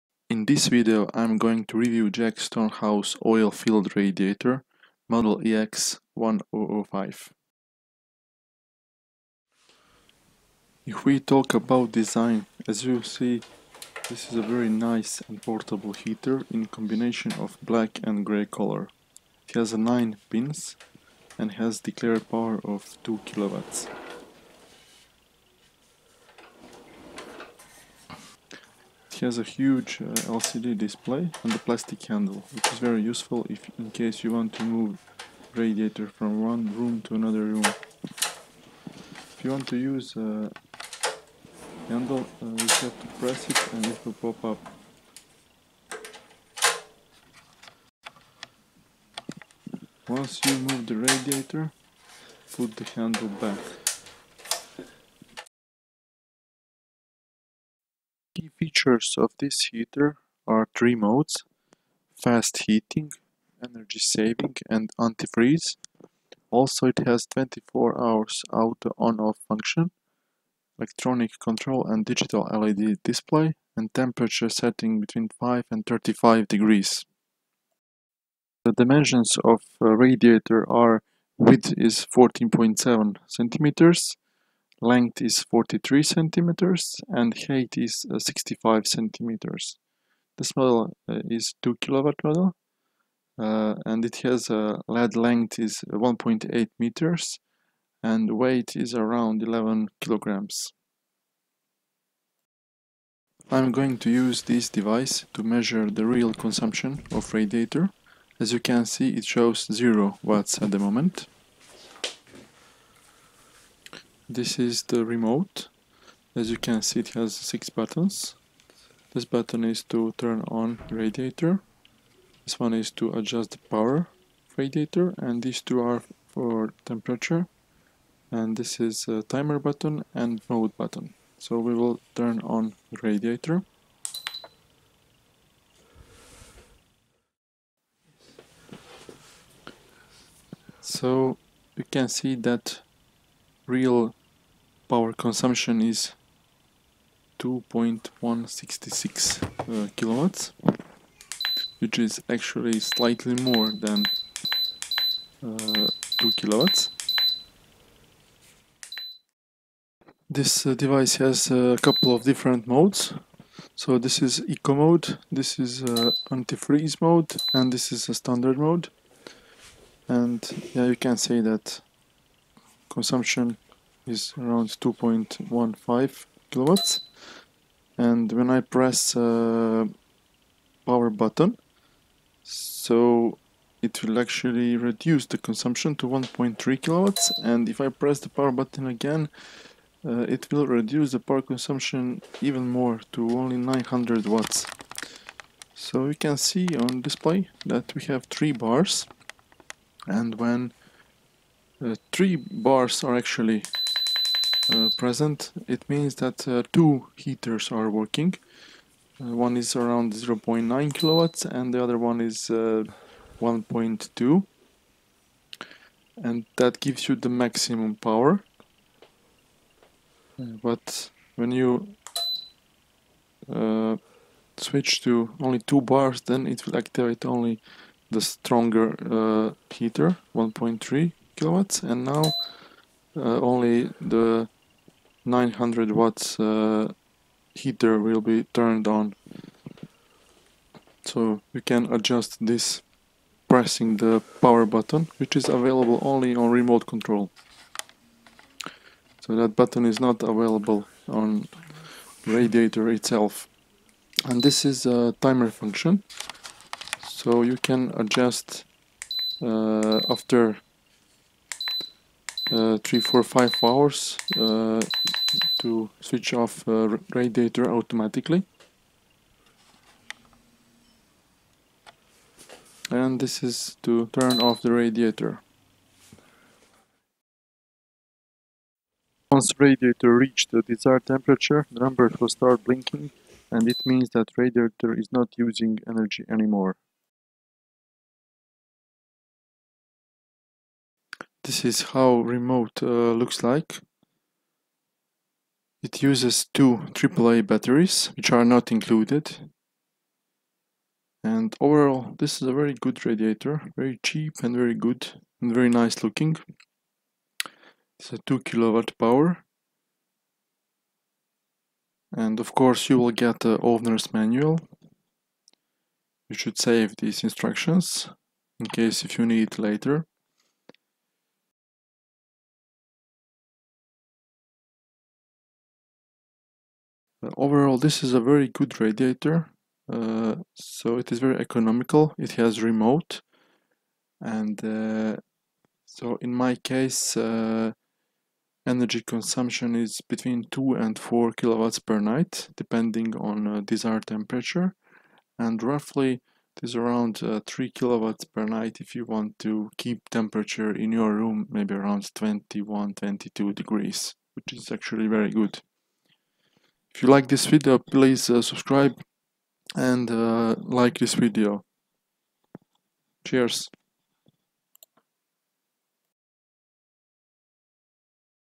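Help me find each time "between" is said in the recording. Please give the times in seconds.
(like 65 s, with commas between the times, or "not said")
75 s, 340 s.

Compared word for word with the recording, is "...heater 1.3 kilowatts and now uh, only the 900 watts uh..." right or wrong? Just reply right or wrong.
right.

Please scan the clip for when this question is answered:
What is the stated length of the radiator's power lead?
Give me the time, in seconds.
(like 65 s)
95 s.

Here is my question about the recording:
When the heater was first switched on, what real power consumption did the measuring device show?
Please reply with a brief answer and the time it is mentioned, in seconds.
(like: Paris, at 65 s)
2.166 kilowatts, at 147 s.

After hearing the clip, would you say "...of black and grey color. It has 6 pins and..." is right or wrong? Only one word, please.
wrong.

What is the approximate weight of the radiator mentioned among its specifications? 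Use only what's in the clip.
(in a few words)
11 kilograms.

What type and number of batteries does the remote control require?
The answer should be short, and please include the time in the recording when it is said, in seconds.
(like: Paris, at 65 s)
2 AAA batteries, at 296 s.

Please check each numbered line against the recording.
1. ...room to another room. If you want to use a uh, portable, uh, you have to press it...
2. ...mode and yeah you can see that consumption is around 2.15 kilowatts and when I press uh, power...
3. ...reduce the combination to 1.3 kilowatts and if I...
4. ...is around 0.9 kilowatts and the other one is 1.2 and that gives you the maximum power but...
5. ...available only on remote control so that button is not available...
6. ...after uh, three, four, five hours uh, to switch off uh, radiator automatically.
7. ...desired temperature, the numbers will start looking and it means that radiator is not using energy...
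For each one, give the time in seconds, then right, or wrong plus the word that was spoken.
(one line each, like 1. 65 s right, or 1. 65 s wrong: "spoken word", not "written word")
1. 36 s wrong: "handle", not "portable"
2. 168 s right
3. 184 s wrong: "consumption", not "combination"
4. 209 s right
5. 245 s right
6. 260 s right
7. 280 s wrong: "blinking", not "looking".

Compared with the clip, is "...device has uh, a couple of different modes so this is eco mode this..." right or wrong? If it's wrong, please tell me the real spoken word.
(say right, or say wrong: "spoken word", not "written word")
right.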